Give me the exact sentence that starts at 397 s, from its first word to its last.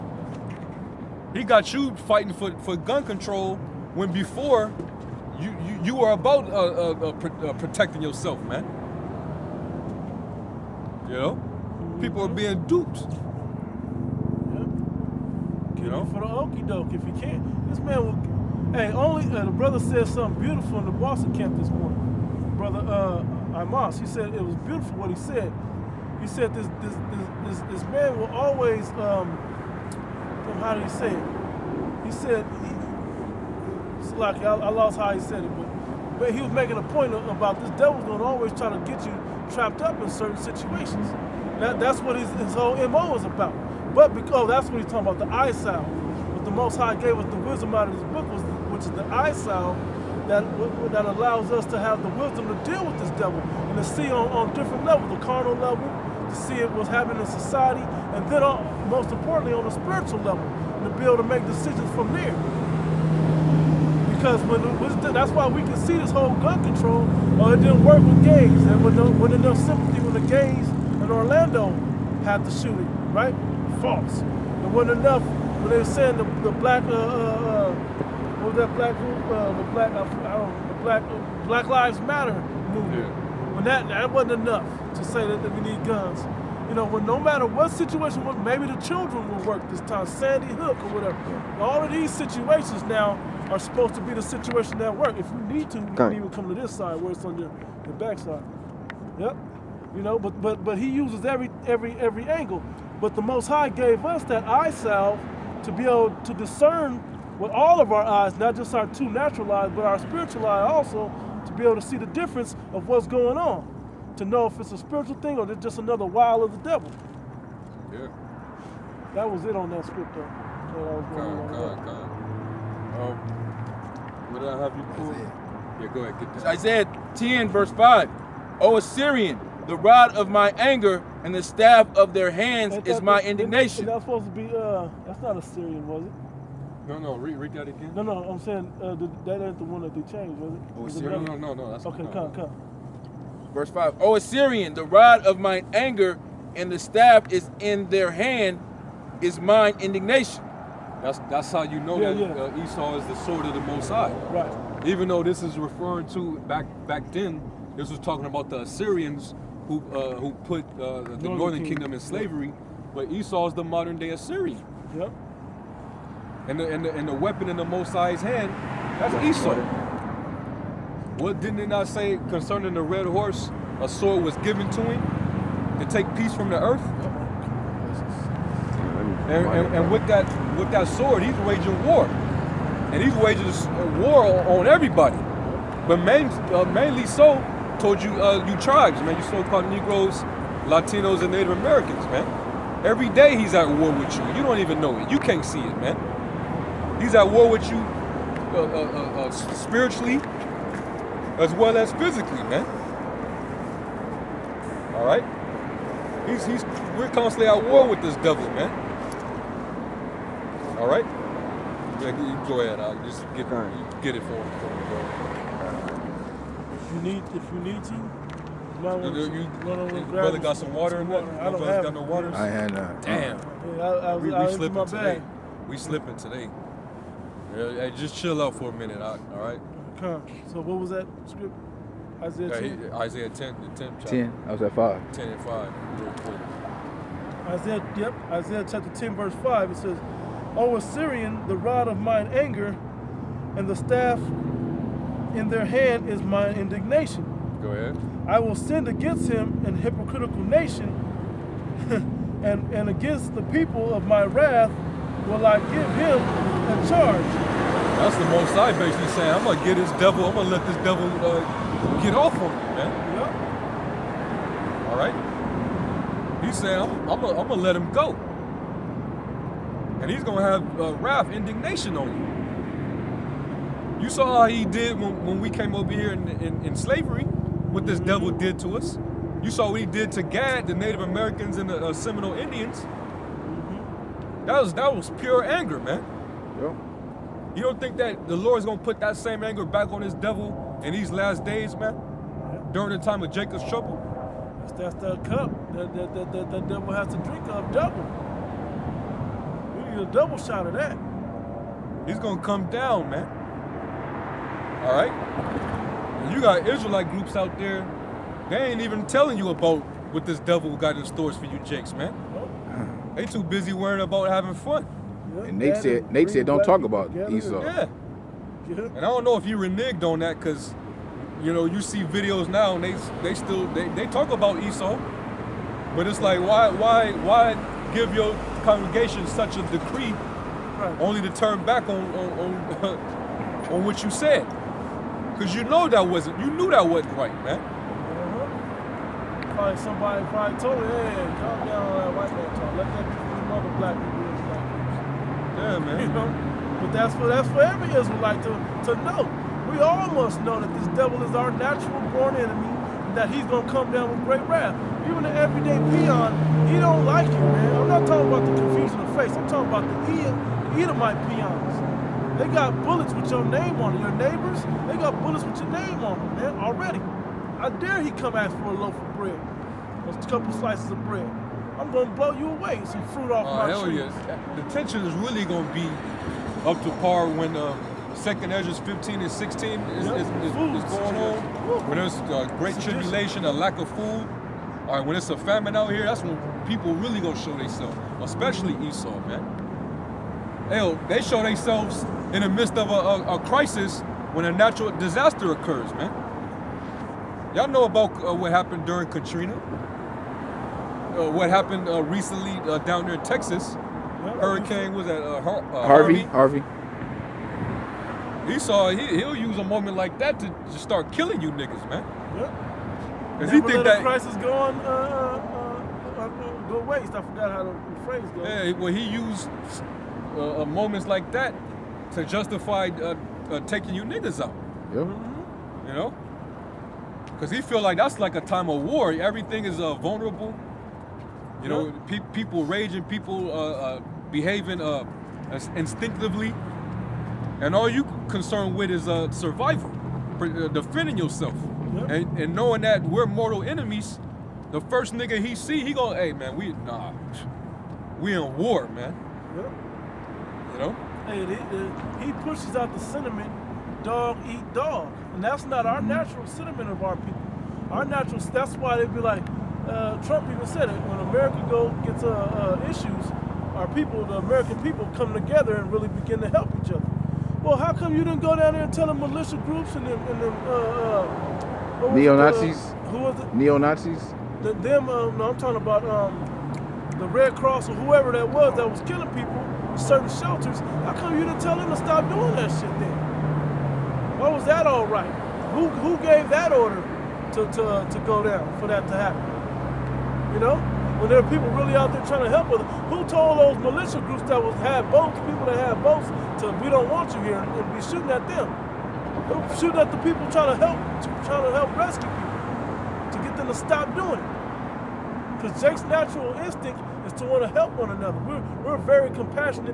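Y'all know about uh, what happened during Katrina uh, what happened uh, recently uh, down there in Texas.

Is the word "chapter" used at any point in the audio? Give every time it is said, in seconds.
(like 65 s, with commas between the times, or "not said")
233 s, 238 s.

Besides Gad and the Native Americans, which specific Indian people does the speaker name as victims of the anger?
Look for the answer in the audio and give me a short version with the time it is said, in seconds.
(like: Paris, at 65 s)
Seminole Indians, at 281 s.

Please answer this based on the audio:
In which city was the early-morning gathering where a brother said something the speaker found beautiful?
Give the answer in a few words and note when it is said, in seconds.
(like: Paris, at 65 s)
Boston, at 20 s.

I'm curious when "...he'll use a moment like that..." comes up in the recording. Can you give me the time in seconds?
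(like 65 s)
409 s.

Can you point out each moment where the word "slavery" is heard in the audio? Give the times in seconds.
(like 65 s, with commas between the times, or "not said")
161 s, 276 s.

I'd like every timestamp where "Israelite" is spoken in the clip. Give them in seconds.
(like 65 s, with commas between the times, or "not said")
306 s, 347 s.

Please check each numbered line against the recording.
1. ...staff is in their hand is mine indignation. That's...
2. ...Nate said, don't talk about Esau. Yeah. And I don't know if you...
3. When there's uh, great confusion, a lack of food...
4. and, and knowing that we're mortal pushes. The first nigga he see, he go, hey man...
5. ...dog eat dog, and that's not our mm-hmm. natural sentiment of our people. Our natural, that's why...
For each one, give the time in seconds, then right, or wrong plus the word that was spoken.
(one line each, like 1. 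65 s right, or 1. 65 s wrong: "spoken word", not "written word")
1. 146 s right
2. 316 s right
3. 381 s wrong: "tribulation", not "confusion"
4. 442 s wrong: "enemies", not "pushes"
5. 454 s right.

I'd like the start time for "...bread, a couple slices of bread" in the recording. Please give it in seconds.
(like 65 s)
369 s.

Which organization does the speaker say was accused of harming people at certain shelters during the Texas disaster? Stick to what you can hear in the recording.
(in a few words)
Red Cross.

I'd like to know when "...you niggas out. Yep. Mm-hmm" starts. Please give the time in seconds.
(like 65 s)
423 s.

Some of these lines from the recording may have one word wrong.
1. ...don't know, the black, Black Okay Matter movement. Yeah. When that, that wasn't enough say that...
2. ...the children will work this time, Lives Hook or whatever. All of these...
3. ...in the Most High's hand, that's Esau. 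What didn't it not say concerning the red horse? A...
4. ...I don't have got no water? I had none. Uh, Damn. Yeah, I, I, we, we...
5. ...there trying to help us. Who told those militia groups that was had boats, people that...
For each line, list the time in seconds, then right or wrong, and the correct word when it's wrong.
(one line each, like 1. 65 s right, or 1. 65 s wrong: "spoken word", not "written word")
1. 80 s wrong: "Lives", not "Okay"
2. 88 s wrong: "Sandy", not "Lives"
3. 167 s right
4. 221 s right
5. 492 s right.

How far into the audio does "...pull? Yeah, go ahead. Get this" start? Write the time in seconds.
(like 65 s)
124 s.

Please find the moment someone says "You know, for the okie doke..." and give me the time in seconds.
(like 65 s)
15 s.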